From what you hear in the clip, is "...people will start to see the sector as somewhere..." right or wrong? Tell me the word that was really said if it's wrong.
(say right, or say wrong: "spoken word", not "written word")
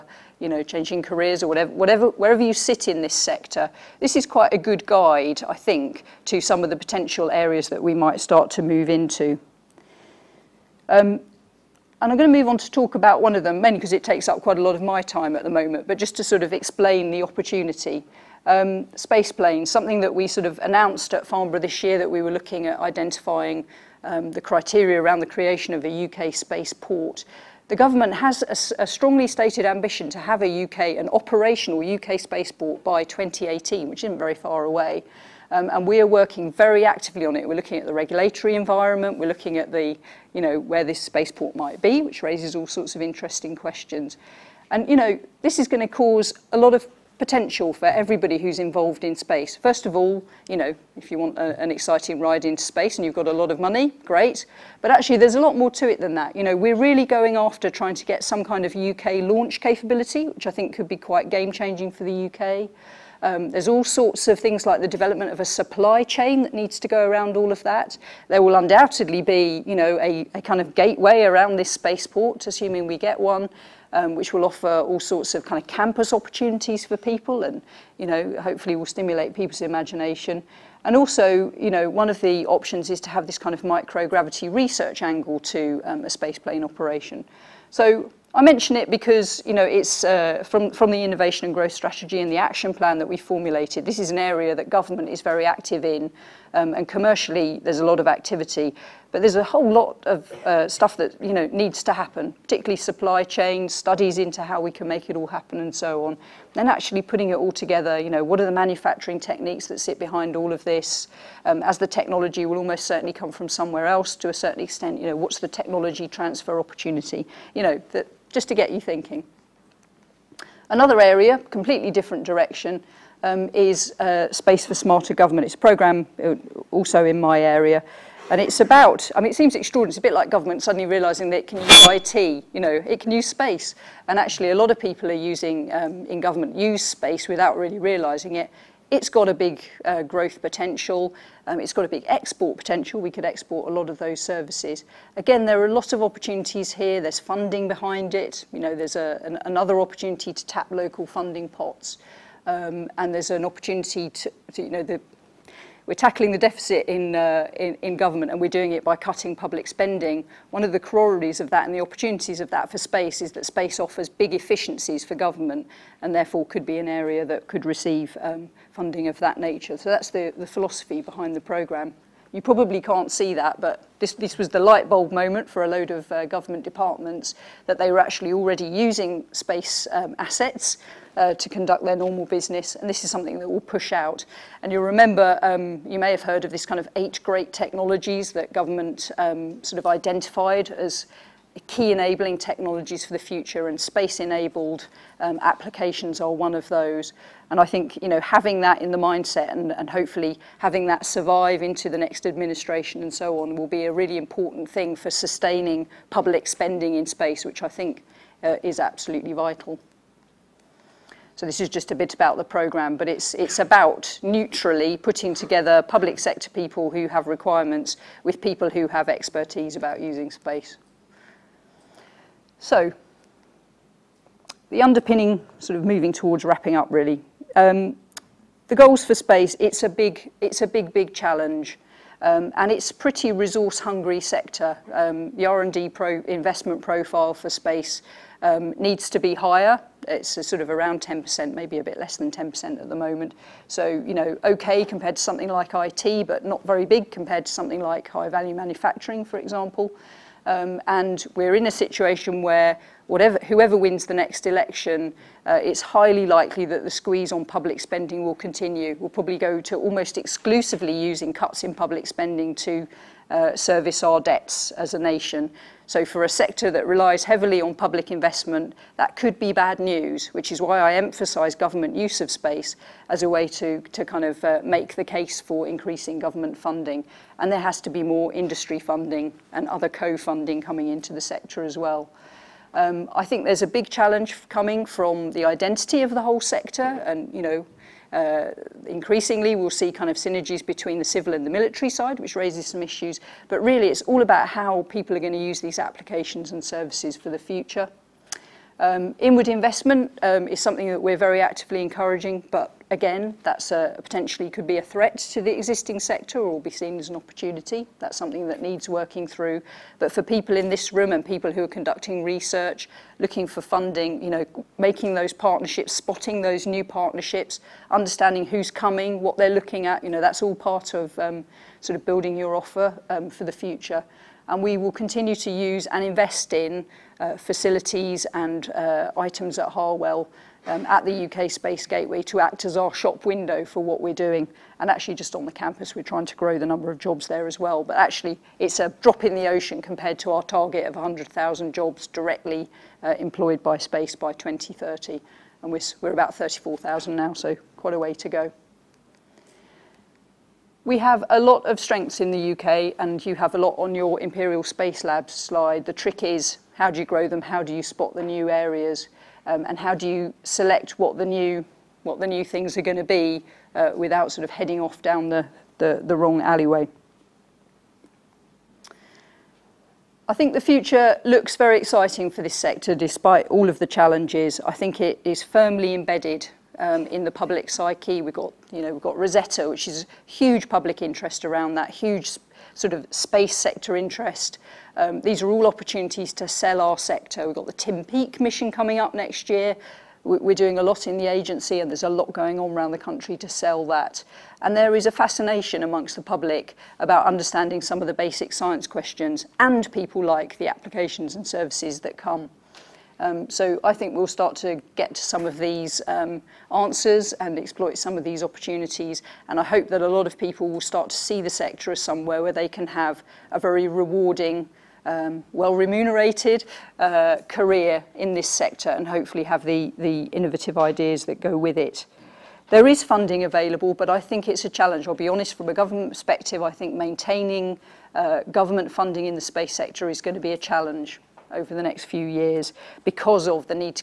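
right.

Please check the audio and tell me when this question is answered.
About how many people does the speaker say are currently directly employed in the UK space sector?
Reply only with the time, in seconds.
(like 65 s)
346 s.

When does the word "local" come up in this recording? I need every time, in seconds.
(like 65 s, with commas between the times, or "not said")
150 s.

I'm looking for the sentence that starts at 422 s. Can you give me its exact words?
There is funding available, but I think it's a challenge.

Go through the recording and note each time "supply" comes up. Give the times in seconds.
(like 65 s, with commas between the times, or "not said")
65 s, 102 s.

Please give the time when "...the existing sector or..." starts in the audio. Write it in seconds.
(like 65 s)
305 s.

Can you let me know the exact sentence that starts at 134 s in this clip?
And actually, a lot of people are using, um, in government, use space without really realizing it.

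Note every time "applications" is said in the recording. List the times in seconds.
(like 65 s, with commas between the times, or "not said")
195 s, 295 s, 400 s.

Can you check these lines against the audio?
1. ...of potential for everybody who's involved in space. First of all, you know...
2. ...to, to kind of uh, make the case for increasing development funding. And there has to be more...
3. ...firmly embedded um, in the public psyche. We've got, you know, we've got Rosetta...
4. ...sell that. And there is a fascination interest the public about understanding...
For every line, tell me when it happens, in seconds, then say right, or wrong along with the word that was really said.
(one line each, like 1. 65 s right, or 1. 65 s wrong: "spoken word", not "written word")
1. 46 s right
2. 273 s wrong: "government", not "development"
3. 375 s right
4. 393 s wrong: "amongst", not "interest".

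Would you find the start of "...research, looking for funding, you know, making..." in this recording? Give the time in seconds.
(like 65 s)
312 s.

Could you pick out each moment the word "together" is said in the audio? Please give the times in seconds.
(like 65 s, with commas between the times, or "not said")
107 s, 215 s.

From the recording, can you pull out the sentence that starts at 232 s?
Um, and it's a pretty resource hungry sector.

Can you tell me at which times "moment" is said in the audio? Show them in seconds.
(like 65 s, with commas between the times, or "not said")
15 s, 175 s, 242 s.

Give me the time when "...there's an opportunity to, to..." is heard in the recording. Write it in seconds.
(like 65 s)
153 s.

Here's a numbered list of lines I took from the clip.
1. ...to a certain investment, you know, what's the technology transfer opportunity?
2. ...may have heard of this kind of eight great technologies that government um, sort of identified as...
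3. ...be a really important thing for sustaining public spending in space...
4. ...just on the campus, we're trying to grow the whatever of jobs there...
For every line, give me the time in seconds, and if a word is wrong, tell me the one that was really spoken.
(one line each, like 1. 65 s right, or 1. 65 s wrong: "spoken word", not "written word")
1. 114 s wrong: "extent", not "investment"
2. 185 s right
3. 203 s right
4. 335 s wrong: "number", not "whatever".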